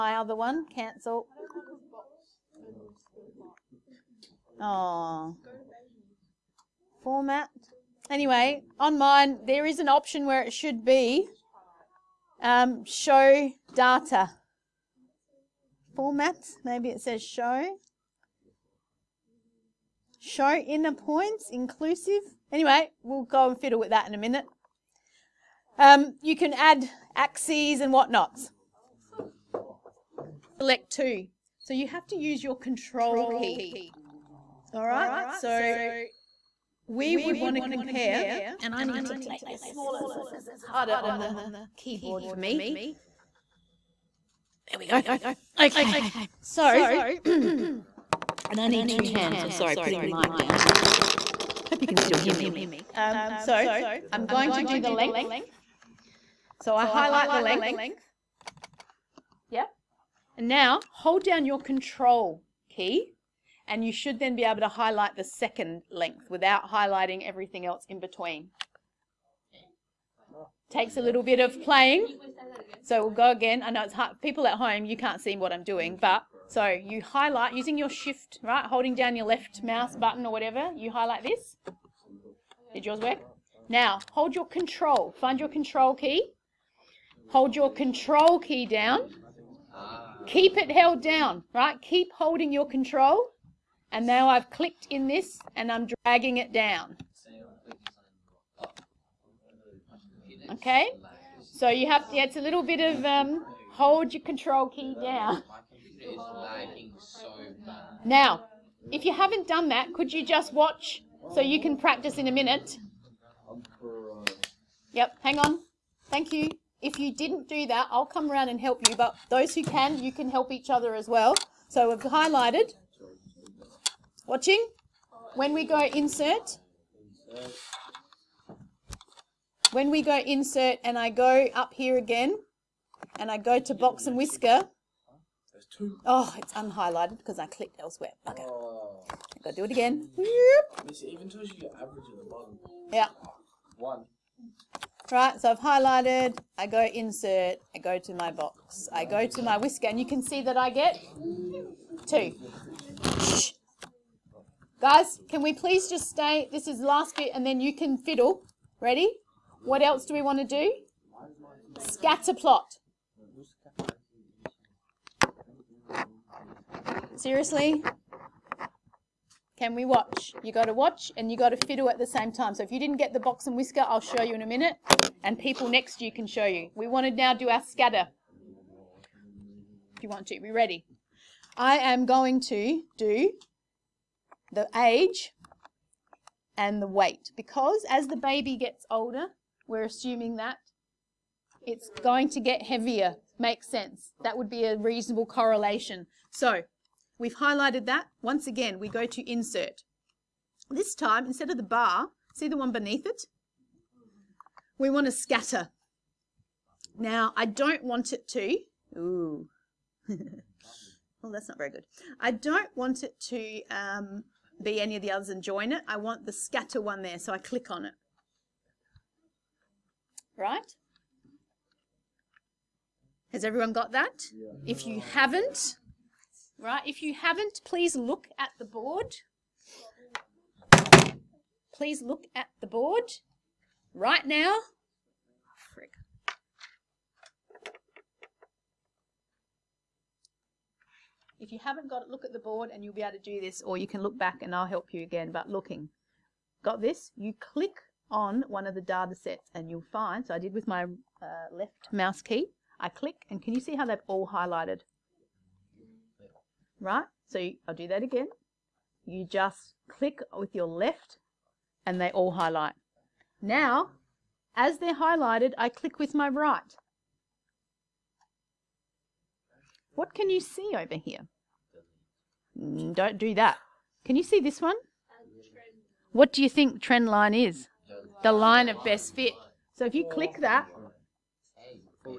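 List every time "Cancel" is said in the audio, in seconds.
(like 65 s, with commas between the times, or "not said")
0 s.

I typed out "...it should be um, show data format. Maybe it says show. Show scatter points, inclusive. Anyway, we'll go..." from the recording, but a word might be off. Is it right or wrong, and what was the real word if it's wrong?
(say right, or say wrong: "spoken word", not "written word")
wrong: "inner", not "scatter".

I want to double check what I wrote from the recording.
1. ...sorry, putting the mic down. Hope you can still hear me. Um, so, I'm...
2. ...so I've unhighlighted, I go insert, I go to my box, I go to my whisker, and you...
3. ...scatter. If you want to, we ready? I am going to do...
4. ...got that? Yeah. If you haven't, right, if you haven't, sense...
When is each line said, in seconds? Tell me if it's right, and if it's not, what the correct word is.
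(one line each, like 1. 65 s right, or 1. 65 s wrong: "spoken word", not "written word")
1. 49 s right
2. 145 s wrong: "highlighted", not "unhighlighted"
3. 177 s right
4. 223 s wrong: "please", not "sense".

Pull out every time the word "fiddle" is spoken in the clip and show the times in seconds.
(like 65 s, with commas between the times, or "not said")
23 s, 157 s, 171 s.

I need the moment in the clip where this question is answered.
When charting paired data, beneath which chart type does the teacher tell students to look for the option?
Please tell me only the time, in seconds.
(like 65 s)
201 s.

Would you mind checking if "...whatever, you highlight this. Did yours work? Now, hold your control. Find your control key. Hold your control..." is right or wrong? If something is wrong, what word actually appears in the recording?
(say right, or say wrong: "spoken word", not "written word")
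right.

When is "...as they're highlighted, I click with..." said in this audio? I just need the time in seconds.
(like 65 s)
264 s.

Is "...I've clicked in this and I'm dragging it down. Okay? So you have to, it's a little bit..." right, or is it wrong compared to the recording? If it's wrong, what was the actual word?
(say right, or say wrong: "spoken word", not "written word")
right.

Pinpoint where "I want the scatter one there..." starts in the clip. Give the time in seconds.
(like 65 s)
215 s.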